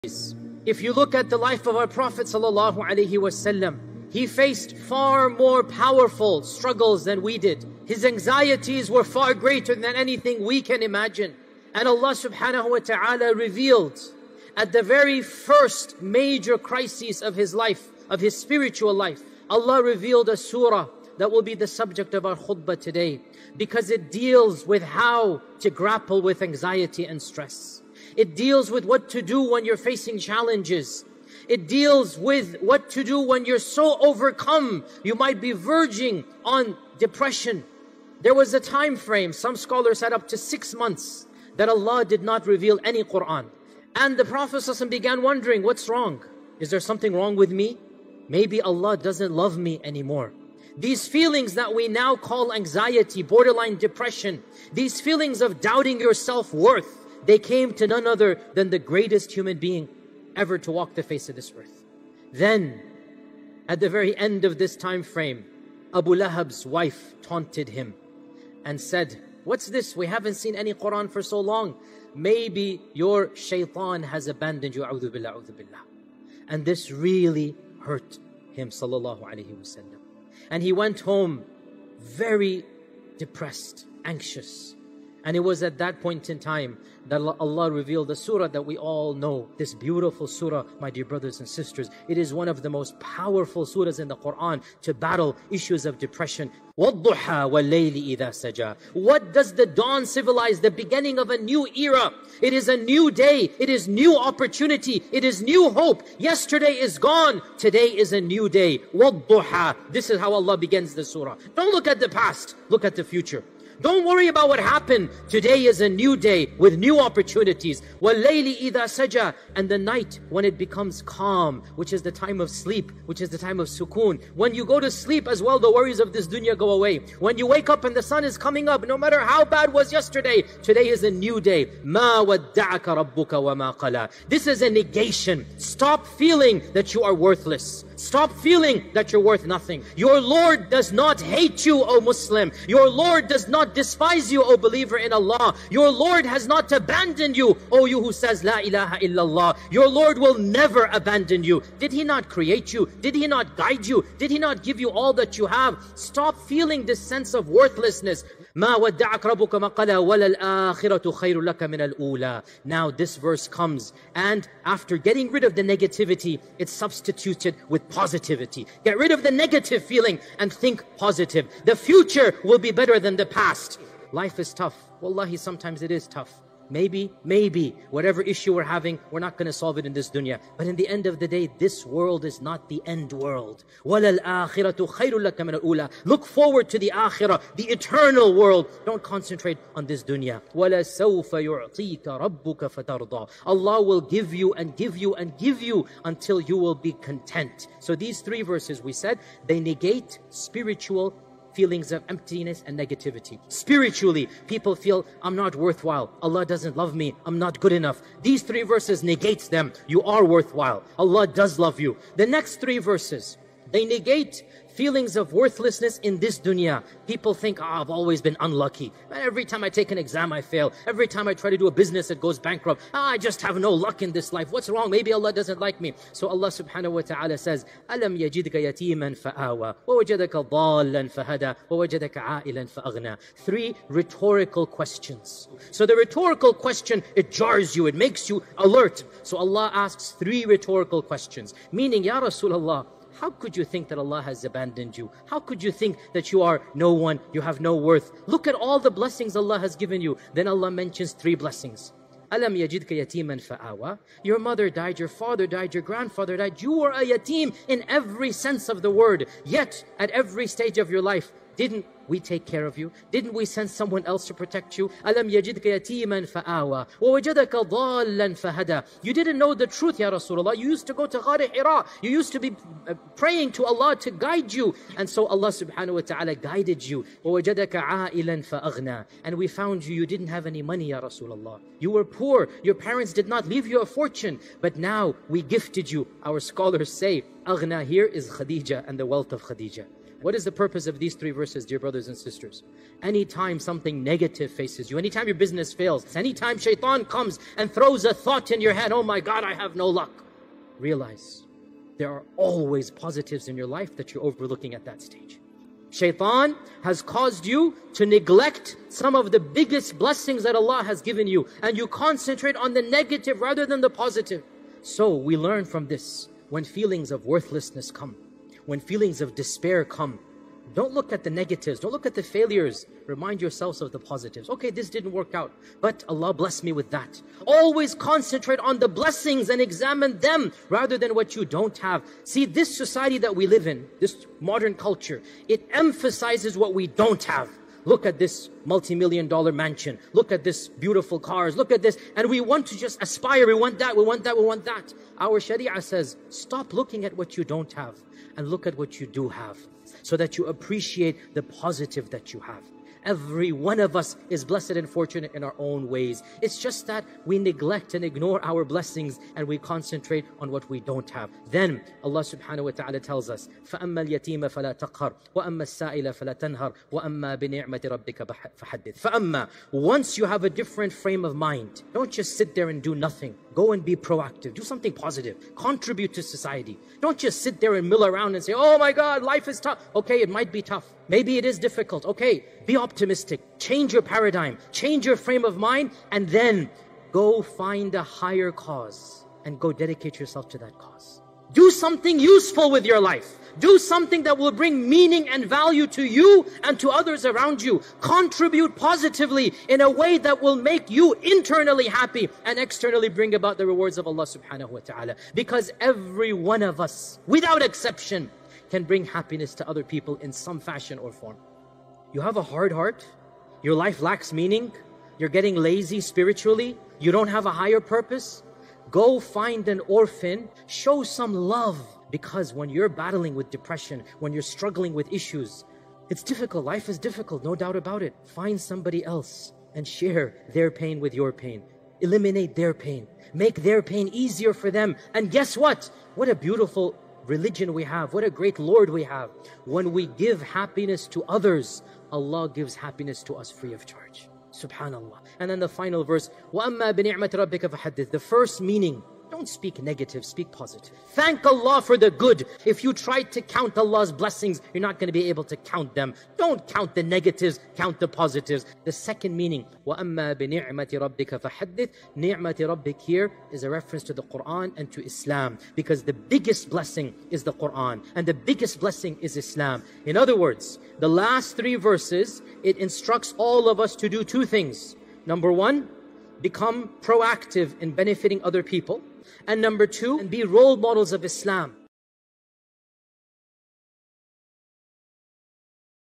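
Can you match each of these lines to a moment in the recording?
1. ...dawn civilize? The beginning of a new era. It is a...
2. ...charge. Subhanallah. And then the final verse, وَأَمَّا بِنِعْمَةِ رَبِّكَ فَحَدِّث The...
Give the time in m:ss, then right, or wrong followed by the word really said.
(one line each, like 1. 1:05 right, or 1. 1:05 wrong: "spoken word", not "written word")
1. 1:39 right
2. 7:23 right.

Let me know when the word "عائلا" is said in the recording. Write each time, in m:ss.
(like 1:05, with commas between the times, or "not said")
3:52.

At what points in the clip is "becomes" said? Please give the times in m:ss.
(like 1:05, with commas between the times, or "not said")
2:00, 7:56.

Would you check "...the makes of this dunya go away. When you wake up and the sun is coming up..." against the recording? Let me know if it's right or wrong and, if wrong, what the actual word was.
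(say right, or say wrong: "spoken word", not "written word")
wrong: "worries", not "makes".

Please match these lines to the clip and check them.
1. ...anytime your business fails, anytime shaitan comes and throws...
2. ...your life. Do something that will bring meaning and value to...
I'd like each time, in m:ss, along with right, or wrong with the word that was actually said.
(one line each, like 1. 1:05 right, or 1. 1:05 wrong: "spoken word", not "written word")
1. 4:54 right
2. 6:32 right.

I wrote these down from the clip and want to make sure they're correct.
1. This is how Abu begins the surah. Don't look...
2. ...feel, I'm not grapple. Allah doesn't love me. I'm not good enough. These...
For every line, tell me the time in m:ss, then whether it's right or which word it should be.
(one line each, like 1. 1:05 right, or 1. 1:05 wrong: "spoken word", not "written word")
1. 1:49 wrong: "Allah", not "Abu"
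2. 3:24 wrong: "worthwhile", not "grapple".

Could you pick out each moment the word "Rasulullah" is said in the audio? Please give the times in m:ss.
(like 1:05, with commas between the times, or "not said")
4:02, 4:30, 4:41.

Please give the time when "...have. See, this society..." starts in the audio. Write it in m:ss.
5:31.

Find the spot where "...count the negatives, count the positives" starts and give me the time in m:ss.
7:36.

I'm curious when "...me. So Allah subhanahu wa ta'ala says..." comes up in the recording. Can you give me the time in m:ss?
3:45.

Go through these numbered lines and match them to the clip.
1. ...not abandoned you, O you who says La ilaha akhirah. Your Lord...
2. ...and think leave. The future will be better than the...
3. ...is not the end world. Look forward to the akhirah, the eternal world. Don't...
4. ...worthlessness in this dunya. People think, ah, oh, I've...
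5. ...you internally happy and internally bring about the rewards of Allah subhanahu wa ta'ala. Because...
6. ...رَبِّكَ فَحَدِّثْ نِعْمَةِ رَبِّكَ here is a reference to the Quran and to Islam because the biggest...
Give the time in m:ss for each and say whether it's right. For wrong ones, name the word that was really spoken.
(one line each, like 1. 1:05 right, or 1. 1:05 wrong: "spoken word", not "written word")
1. 2:26 wrong: "illallah", not "akhirah"
2. 2:50 wrong: "positive", not "leave"
3. 3:02 right
4. 3:35 right
5. 6:40 wrong: "externally", not "internally"
6. 7:41 right.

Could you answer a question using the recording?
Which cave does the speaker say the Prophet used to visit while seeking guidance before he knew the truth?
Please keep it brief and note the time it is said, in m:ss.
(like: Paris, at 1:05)
Ghar Hira, at 4:31.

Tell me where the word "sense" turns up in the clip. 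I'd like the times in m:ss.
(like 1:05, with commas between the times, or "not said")
2:36, 4:18.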